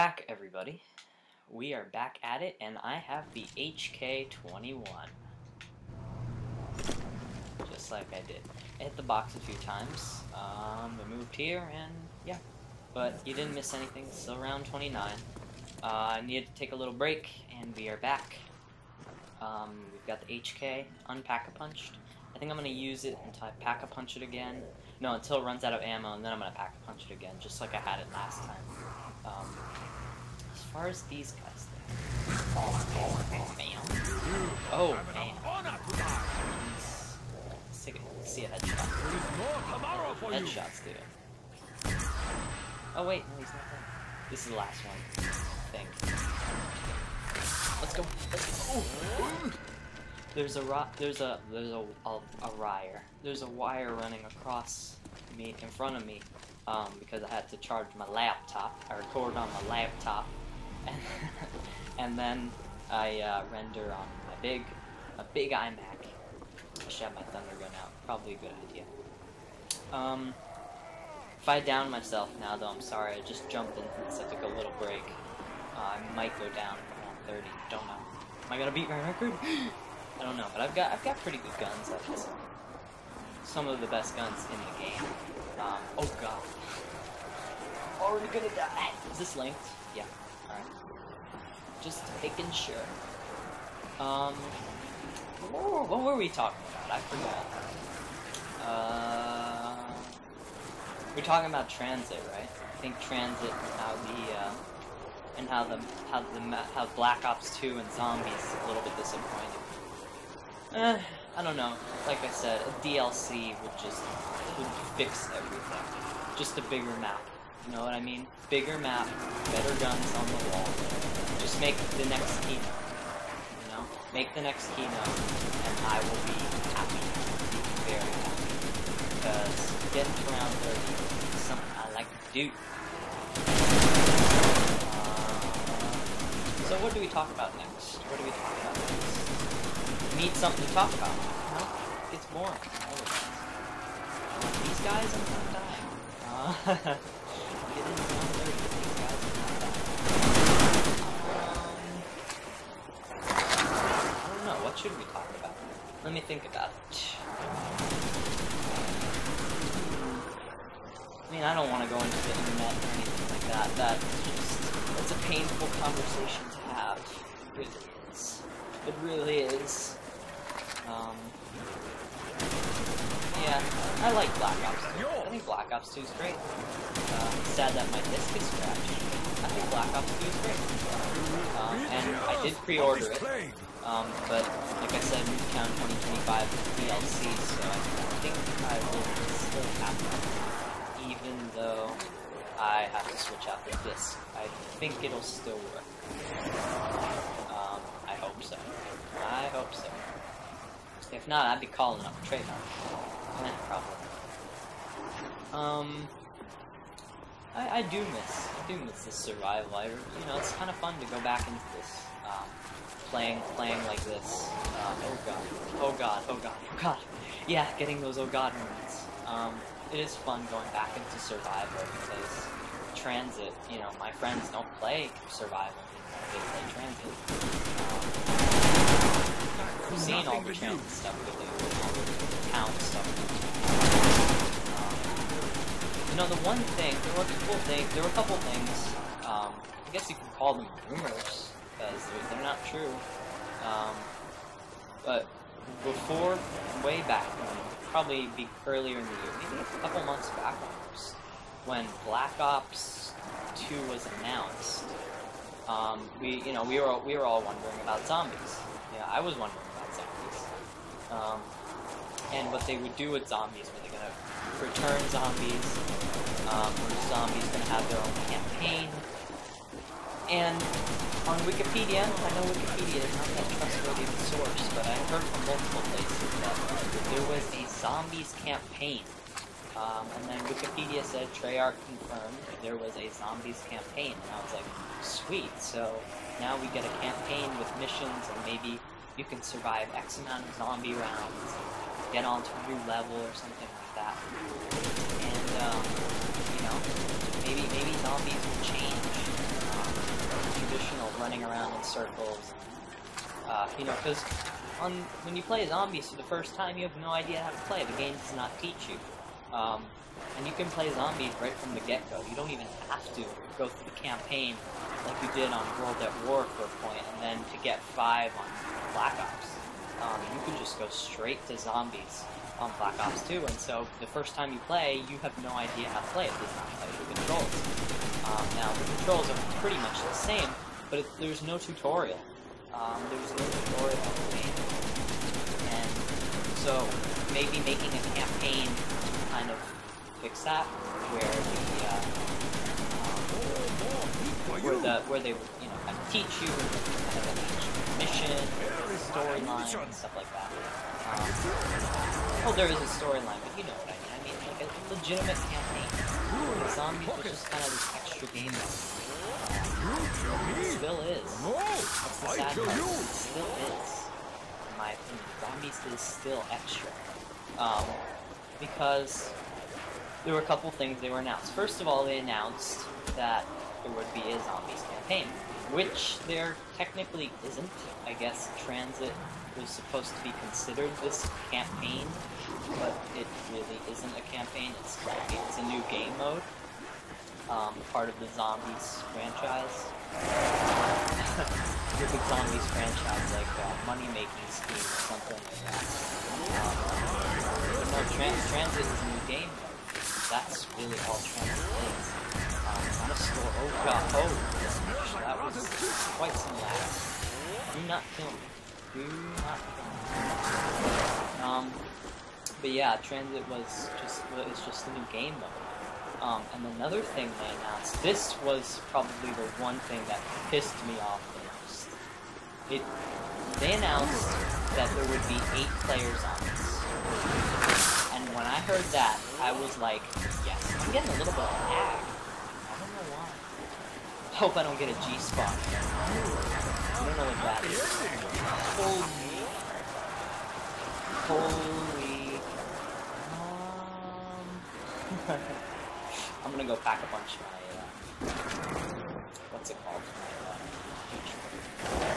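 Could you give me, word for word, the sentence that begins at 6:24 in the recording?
It's it's a new game mode, um, part of the zombies franchise.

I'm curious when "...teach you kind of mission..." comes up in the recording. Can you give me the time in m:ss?
5:46.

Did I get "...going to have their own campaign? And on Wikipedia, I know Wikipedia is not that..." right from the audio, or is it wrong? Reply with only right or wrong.
right.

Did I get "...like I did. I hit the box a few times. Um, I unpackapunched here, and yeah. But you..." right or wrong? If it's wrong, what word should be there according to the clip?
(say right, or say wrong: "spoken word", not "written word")
wrong: "moved", not "unpackapunched".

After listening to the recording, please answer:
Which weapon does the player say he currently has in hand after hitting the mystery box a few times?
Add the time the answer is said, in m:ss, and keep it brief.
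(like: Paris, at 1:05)
HK21, at 0:03.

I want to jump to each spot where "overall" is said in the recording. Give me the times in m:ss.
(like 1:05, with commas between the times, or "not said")
not said.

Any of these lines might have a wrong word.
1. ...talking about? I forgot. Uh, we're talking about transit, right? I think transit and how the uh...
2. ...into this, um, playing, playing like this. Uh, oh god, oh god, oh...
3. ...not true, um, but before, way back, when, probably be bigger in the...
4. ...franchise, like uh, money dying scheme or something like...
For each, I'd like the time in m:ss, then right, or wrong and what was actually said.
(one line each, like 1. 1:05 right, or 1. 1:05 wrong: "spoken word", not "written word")
1. 1:36 right
2. 3:31 right
3. 4:02 wrong: "earlier", not "bigger"
4. 6:32 wrong: "making", not "dying".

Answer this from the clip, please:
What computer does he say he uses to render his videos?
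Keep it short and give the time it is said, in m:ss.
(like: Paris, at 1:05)
iMac, at 1:05.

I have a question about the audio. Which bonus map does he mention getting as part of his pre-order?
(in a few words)
Nuketown 2025.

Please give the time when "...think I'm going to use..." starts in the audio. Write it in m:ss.
0:22.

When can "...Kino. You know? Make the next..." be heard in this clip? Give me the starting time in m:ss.
2:02.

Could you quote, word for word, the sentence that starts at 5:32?
Um, there's no tutorial on the game.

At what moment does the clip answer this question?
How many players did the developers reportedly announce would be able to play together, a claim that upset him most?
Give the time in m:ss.
7:05.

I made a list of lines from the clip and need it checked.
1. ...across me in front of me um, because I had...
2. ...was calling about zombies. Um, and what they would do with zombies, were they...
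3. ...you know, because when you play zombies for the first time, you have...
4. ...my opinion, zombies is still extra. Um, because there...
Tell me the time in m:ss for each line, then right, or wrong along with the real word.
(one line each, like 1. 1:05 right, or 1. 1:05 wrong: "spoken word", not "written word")
1. 0:54 right
2. 4:19 wrong: "wondering", not "calling"
3. 5:03 right
4. 6:04 right.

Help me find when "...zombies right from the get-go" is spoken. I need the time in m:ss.
5:10.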